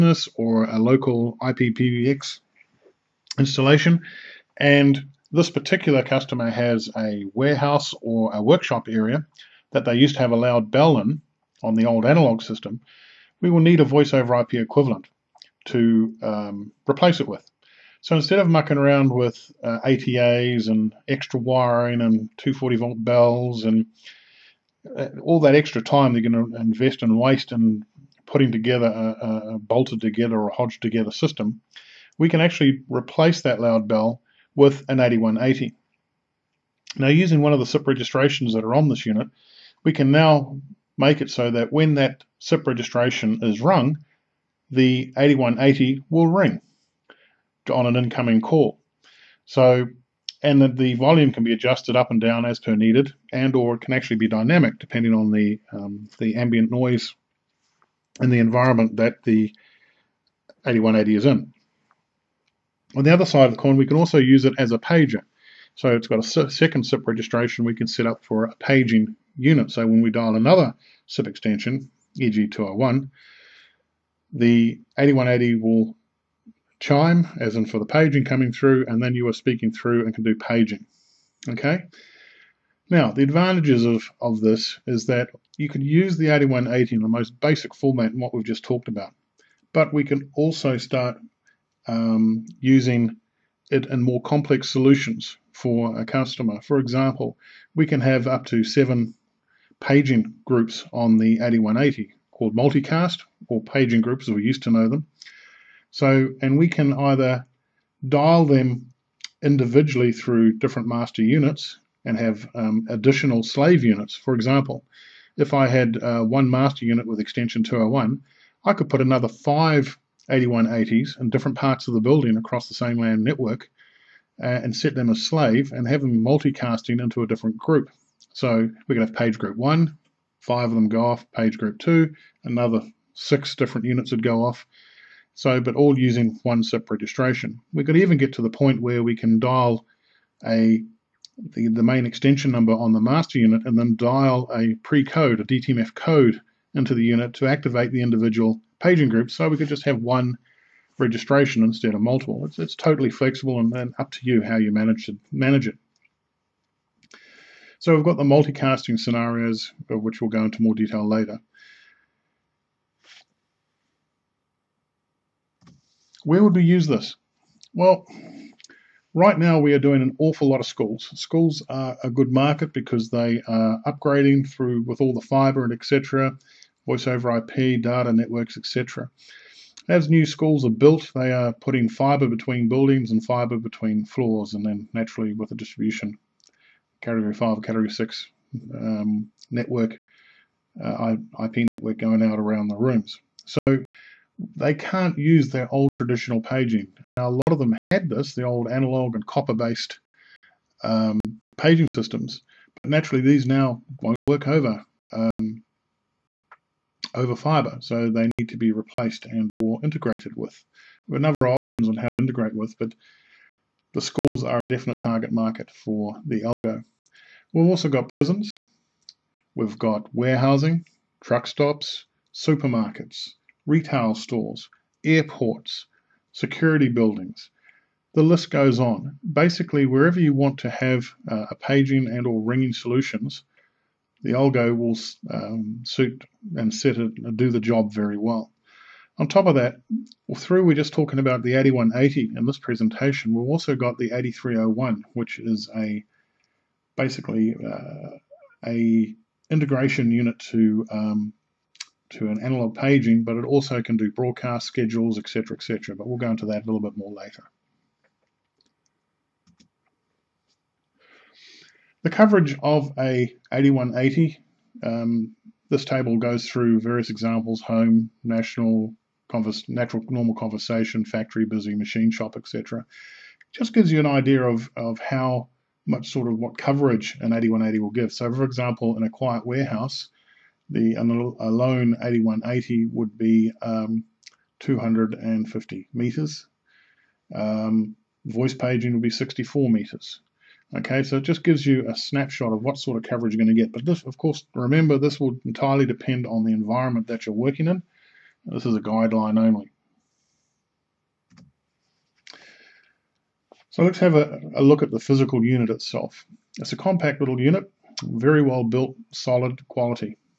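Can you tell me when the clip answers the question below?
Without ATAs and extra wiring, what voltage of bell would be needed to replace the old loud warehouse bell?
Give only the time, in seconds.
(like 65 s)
22 s.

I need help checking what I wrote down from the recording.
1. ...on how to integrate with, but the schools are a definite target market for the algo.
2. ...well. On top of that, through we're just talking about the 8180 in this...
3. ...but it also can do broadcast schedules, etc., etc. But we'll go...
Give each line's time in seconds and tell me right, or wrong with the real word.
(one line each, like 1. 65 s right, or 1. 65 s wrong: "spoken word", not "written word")
1. 211 s right
2. 238 s right
3. 253 s right.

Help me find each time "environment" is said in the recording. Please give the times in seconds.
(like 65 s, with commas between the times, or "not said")
58 s, 296 s.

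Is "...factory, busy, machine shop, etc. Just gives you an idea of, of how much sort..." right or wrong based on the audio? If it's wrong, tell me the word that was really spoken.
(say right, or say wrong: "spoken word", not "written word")
right.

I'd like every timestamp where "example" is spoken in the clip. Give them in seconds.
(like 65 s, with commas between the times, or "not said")
96 s, 114 s, 267 s, 278 s.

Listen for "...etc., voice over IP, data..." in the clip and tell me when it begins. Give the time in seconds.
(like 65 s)
175 s.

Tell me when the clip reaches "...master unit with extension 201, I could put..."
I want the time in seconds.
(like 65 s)
116 s.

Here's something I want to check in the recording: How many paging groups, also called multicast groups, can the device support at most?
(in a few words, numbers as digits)
seven.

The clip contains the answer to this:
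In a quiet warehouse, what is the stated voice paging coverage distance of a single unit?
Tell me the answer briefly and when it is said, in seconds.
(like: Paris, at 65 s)
64 meters, at 289 s.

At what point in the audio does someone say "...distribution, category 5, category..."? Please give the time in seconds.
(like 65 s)
185 s.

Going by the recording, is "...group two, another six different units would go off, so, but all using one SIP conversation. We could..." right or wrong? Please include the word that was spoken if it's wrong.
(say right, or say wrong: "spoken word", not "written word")
wrong: "registration", not "conversation".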